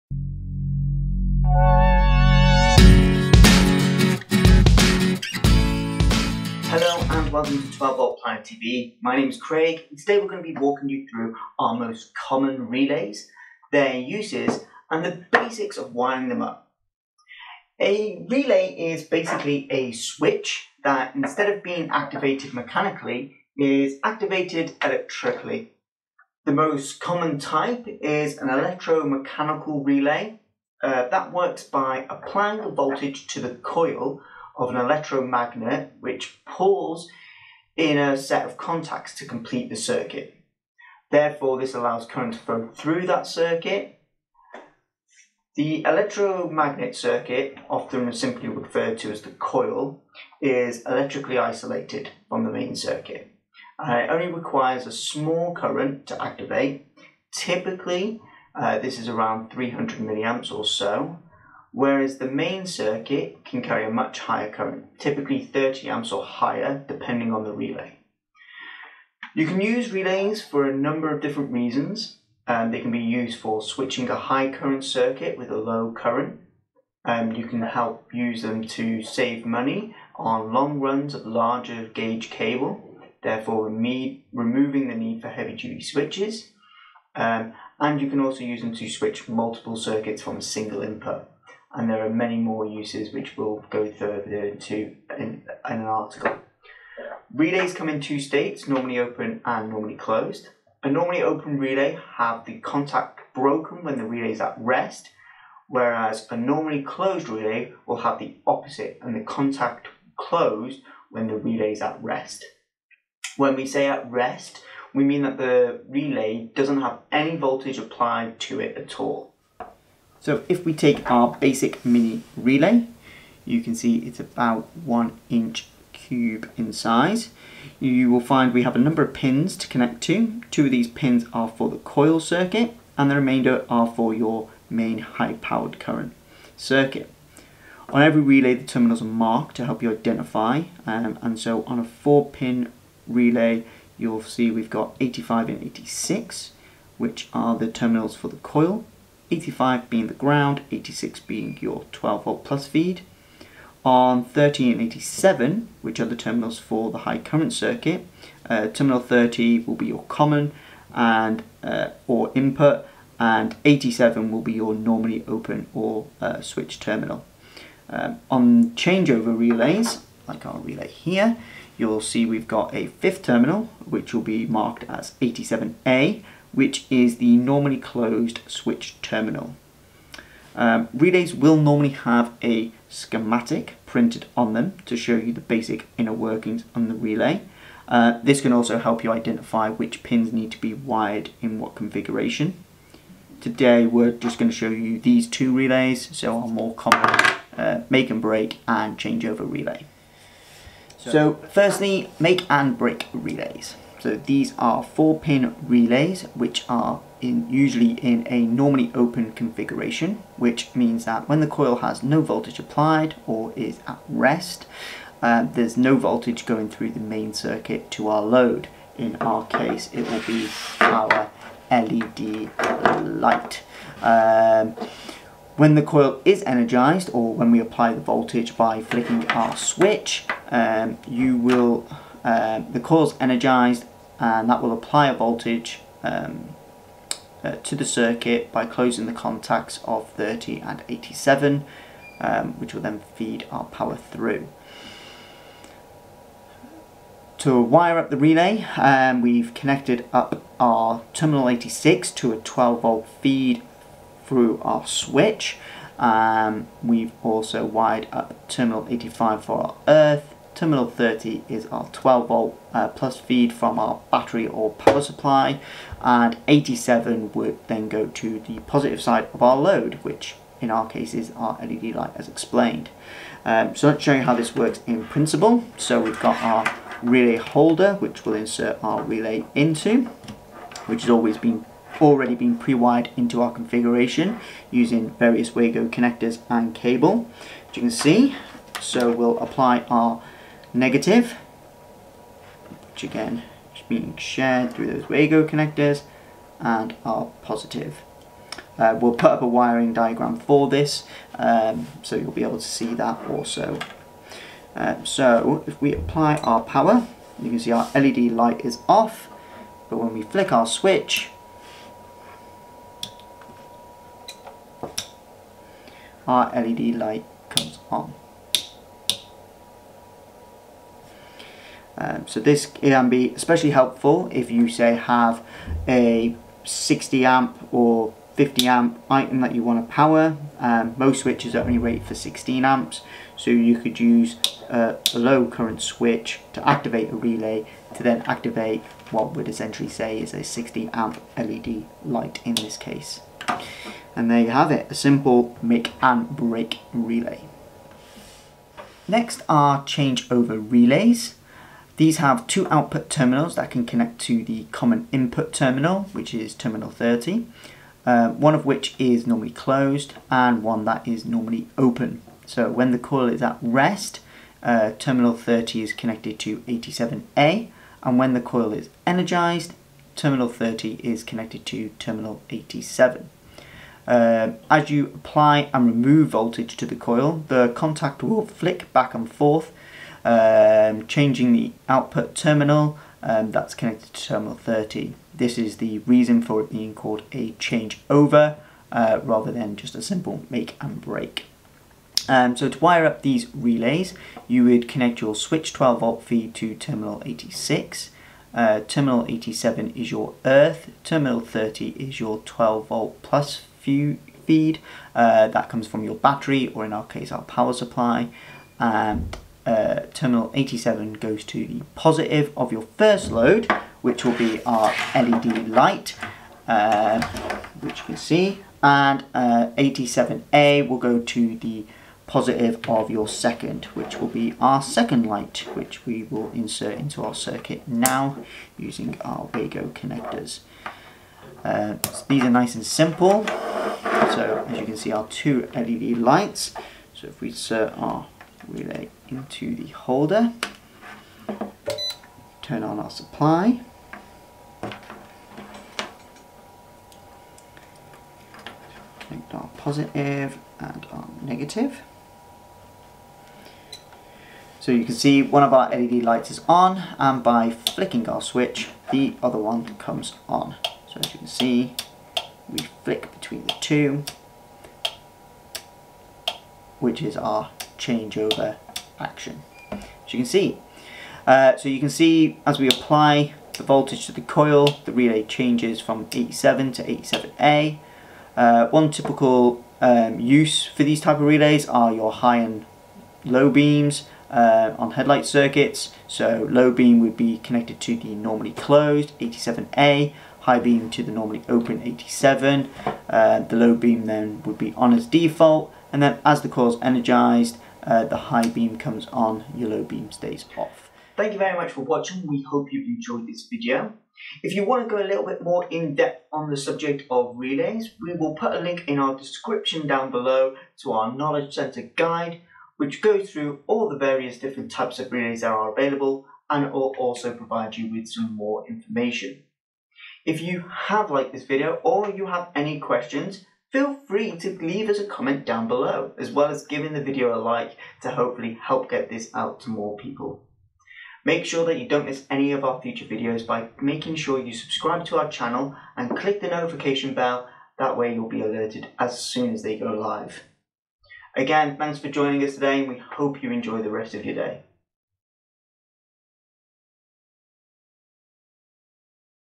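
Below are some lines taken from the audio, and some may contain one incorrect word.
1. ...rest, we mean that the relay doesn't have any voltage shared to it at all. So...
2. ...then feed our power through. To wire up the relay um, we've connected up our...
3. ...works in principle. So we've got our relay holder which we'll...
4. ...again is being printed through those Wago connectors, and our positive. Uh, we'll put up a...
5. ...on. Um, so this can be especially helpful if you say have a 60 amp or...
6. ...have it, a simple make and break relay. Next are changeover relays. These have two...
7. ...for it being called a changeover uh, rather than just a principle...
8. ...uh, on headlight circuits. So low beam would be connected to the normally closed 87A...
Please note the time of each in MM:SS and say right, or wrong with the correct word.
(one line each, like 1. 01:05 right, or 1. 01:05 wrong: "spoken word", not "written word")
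1. 01:54 wrong: "applied", not "shared"
2. 04:02 right
3. 04:34 right
4. 04:53 wrong: "shared", not "printed"
5. 05:17 right
6. 05:44 right
7. 06:26 wrong: "simple", not "principle"
8. 08:04 right.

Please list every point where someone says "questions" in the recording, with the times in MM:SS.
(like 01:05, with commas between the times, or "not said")
08:42.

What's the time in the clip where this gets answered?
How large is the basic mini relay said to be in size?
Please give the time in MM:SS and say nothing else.
02:04.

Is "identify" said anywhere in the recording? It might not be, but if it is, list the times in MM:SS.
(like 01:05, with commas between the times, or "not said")
02:19, 03:09.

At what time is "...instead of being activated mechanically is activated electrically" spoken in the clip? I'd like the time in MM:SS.
00:21.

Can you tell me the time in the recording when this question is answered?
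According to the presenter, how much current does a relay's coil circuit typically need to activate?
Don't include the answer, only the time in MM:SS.
00:59.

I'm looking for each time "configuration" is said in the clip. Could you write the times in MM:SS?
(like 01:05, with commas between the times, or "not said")
03:11, 03:29, 04:43.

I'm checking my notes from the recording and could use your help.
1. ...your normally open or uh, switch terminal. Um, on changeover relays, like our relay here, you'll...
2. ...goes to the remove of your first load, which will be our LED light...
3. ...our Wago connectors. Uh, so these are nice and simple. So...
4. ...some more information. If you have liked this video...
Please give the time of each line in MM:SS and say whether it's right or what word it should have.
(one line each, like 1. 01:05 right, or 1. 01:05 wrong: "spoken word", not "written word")
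1. 02:44 right
2. 06:51 wrong: "positive", not "remove"
3. 07:09 right
4. 08:38 right.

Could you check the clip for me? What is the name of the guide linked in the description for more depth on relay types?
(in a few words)
Knowledge Center guide.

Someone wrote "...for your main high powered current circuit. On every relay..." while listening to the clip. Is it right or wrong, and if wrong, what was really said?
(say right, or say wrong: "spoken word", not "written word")
right.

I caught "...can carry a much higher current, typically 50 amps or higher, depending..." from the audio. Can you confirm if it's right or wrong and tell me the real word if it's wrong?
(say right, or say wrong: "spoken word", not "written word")
wrong: "30", not "50".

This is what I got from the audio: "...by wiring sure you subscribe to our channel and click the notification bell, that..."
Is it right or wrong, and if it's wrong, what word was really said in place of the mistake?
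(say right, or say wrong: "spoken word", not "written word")
wrong: "making", not "wiring".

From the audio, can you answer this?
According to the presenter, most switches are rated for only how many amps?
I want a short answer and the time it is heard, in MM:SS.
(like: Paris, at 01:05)
16 amps, at 05:32.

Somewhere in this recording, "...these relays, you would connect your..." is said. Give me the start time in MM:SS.
06:33.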